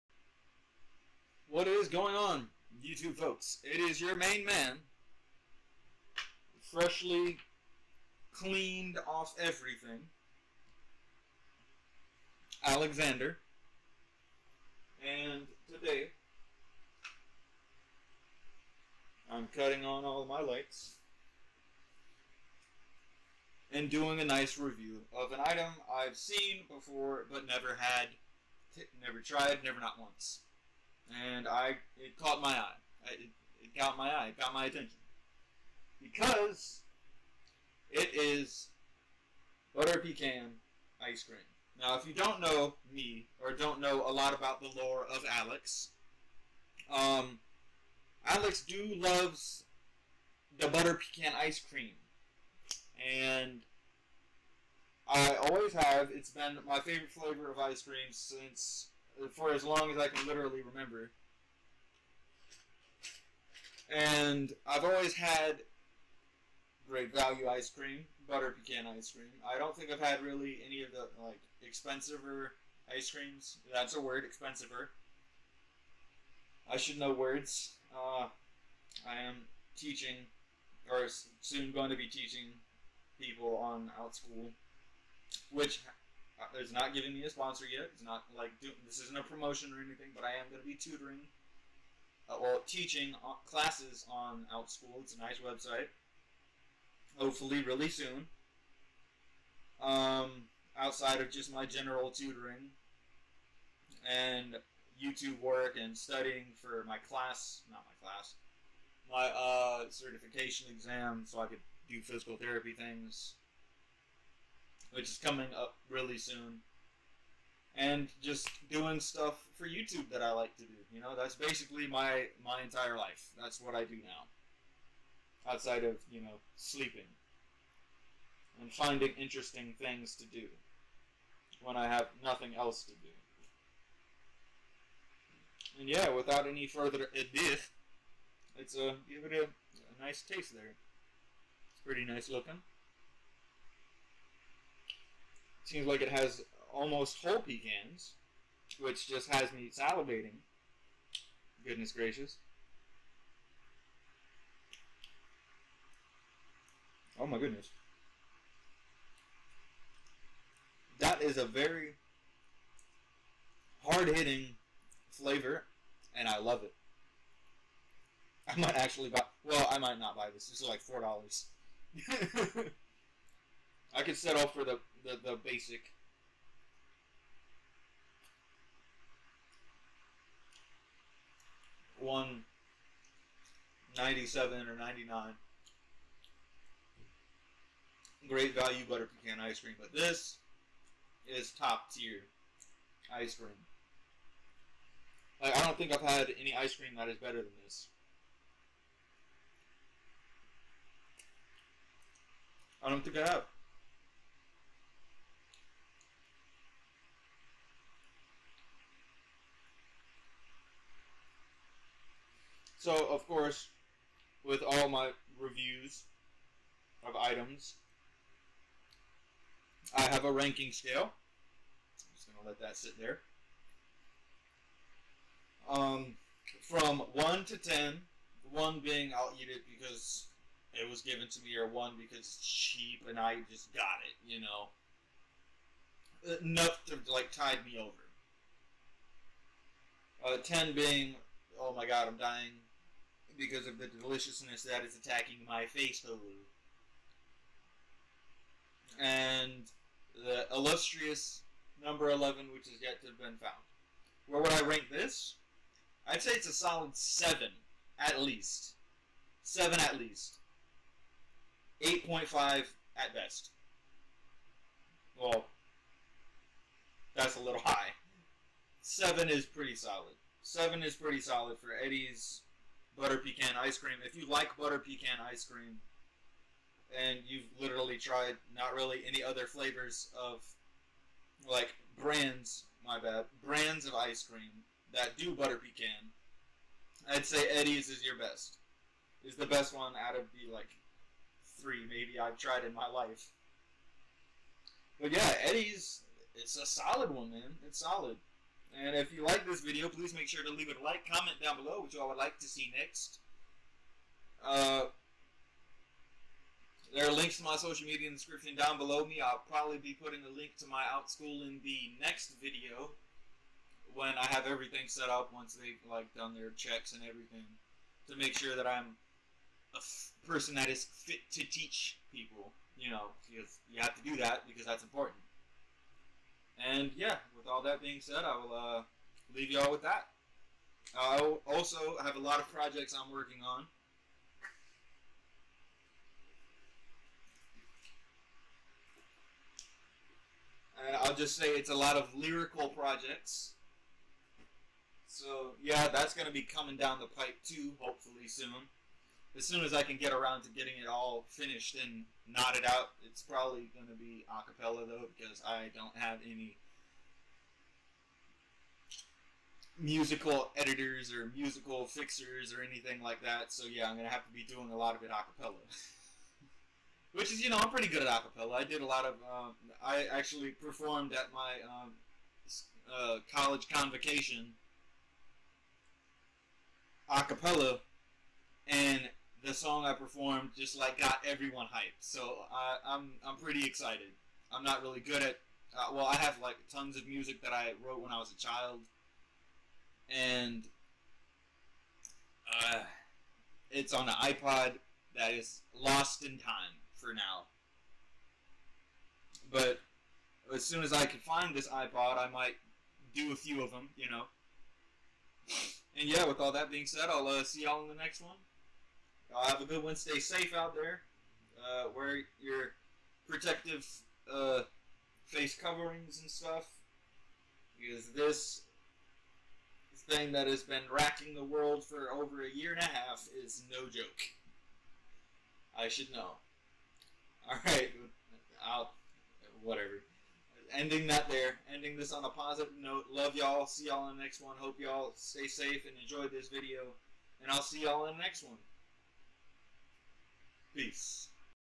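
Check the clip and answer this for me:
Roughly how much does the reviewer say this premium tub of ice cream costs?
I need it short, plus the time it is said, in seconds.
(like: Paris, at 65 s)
4 dollars, at 170 s.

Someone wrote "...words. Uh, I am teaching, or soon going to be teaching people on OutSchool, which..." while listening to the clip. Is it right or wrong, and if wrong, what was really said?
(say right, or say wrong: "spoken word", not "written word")
right.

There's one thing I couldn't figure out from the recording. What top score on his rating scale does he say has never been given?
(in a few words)
11.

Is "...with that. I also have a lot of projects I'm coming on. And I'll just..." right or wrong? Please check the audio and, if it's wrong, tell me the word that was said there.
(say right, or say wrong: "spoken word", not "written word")
wrong: "working", not "coming".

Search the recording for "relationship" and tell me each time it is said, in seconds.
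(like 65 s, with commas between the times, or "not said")
not said.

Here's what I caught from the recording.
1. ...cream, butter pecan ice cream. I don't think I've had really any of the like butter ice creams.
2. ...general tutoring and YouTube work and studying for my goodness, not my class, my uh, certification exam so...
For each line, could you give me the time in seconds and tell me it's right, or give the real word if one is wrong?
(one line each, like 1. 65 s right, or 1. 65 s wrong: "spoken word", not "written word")
1. 67 s wrong: "expensiver", not "butter"
2. 101 s wrong: "class", not "goodness".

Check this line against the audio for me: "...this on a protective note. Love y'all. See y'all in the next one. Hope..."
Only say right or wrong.
wrong.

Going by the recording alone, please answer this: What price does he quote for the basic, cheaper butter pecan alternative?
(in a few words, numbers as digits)
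1.97.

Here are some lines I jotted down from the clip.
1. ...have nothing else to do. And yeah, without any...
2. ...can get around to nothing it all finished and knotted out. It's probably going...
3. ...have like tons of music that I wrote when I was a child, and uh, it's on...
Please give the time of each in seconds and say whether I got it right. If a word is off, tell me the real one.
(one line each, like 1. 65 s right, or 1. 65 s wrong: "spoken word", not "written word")
1. 131 s right
2. 349 s wrong: "getting", not "nothing"
3. 386 s right.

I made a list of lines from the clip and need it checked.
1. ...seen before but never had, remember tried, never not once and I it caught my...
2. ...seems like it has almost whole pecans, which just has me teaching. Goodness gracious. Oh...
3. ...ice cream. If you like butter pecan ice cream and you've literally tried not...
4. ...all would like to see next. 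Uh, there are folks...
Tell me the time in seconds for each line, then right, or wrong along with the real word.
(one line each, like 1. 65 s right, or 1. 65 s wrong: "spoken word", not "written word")
1. 26 s wrong: "never", not "remember"
2. 145 s wrong: "salivating", not "teaching"
3. 273 s right
4. 302 s wrong: "links", not "folks".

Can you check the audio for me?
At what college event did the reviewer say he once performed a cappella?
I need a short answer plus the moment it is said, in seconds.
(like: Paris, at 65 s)
Convocation, at 373 s.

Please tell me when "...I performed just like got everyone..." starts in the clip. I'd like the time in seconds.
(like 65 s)
379 s.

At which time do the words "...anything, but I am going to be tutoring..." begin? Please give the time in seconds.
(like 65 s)
89 s.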